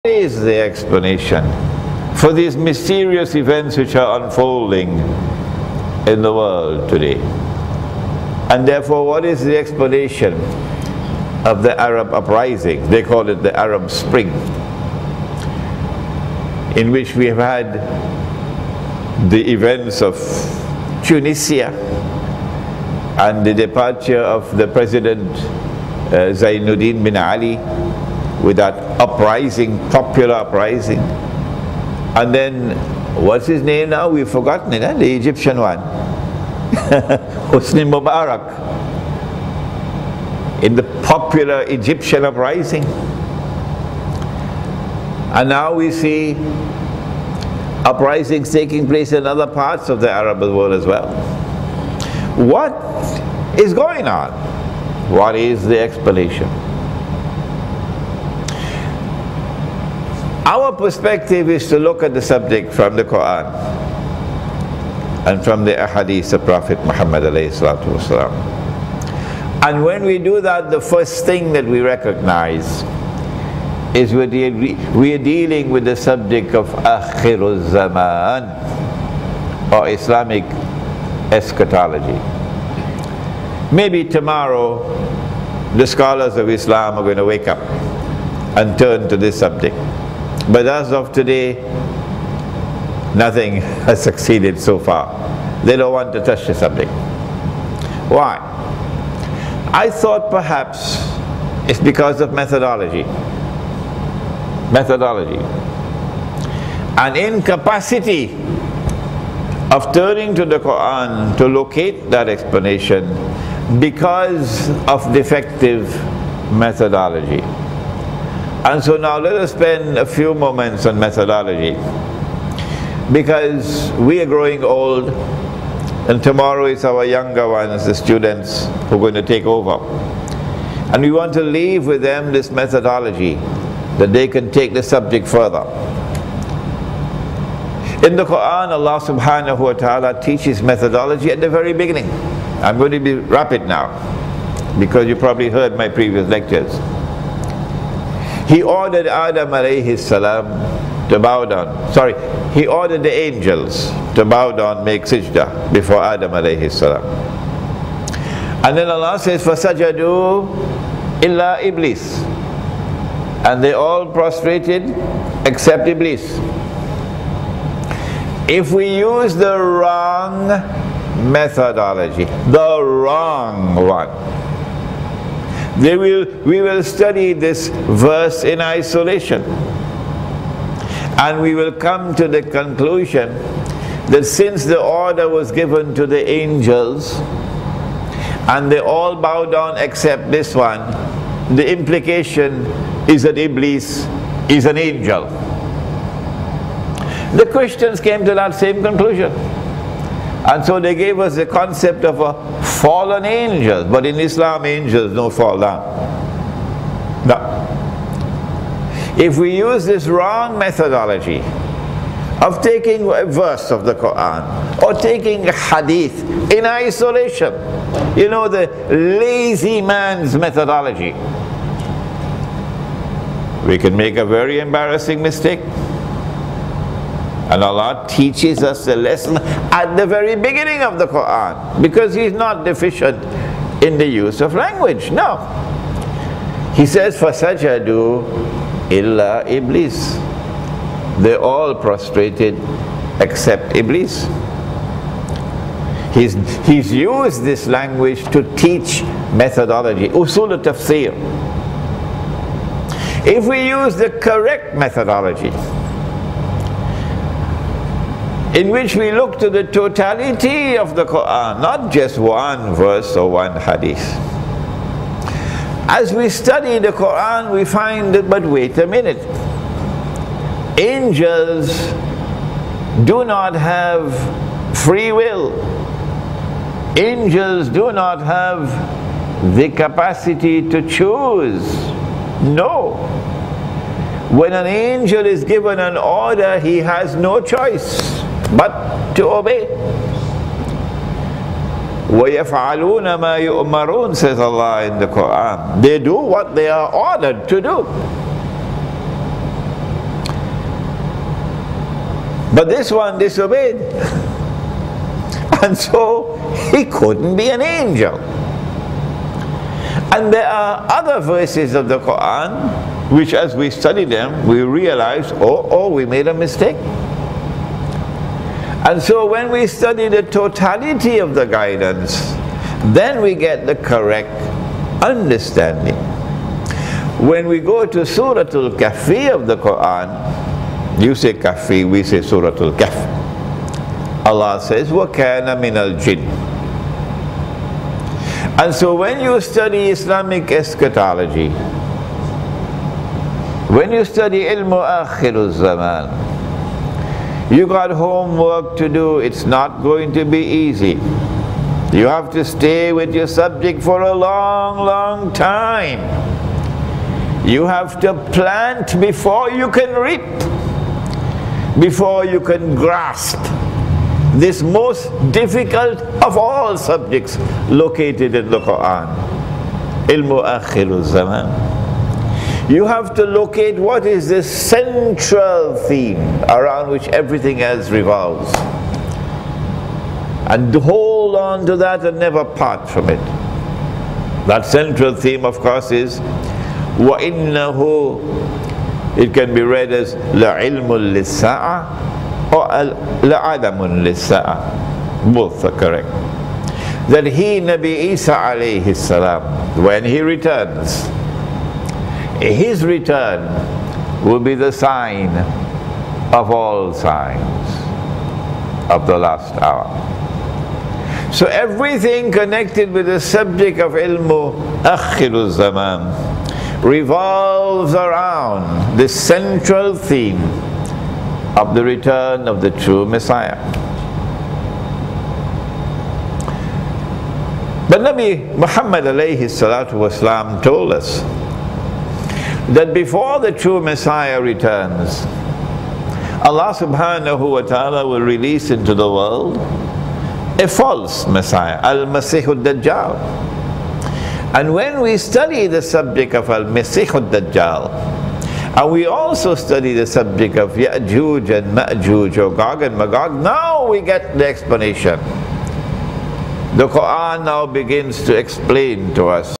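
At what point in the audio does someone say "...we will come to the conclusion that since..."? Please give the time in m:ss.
3:01.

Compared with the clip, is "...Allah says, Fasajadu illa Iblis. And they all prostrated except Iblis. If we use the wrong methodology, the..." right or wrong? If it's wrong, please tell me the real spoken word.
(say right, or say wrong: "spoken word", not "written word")
right.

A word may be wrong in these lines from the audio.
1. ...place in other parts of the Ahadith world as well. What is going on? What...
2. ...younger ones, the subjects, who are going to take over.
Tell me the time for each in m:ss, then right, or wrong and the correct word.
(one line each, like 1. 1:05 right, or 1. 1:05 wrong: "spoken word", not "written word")
1. 0:48 wrong: "Arab", not "Ahadith"
2. 2:07 wrong: "students", not "subjects".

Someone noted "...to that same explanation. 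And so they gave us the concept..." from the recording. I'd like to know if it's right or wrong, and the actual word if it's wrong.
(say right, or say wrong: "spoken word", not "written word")
wrong: "conclusion", not "explanation".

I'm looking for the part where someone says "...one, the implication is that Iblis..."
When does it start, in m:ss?
3:10.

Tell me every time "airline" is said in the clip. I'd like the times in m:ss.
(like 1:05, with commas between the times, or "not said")
not said.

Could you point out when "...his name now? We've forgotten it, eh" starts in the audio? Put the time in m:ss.
0:33.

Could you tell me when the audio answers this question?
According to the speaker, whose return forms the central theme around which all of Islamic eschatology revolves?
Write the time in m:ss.
6:37.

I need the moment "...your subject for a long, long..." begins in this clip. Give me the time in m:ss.
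5:53.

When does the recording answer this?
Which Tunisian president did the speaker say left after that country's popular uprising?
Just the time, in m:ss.
0:26.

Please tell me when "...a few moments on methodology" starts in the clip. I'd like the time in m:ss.
1:59.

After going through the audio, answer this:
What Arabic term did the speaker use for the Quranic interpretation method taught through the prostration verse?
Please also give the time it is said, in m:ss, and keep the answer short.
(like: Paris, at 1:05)
usul tafsir, at 4:10.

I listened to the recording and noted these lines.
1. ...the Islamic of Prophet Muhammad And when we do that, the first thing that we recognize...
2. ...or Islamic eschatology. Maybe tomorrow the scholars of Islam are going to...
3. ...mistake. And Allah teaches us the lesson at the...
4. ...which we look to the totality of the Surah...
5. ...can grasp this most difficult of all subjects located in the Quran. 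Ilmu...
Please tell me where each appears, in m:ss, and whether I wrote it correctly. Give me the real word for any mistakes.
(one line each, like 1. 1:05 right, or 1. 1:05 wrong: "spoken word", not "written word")
1. 1:05 wrong: "Ahadith", not "Islamic"
2. 1:19 right
3. 3:45 right
4. 4:18 wrong: "Quran", not "Surah"
5. 6:02 right.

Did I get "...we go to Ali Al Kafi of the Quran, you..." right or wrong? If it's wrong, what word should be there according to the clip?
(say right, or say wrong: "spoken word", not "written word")
wrong: "Surah", not "Ali".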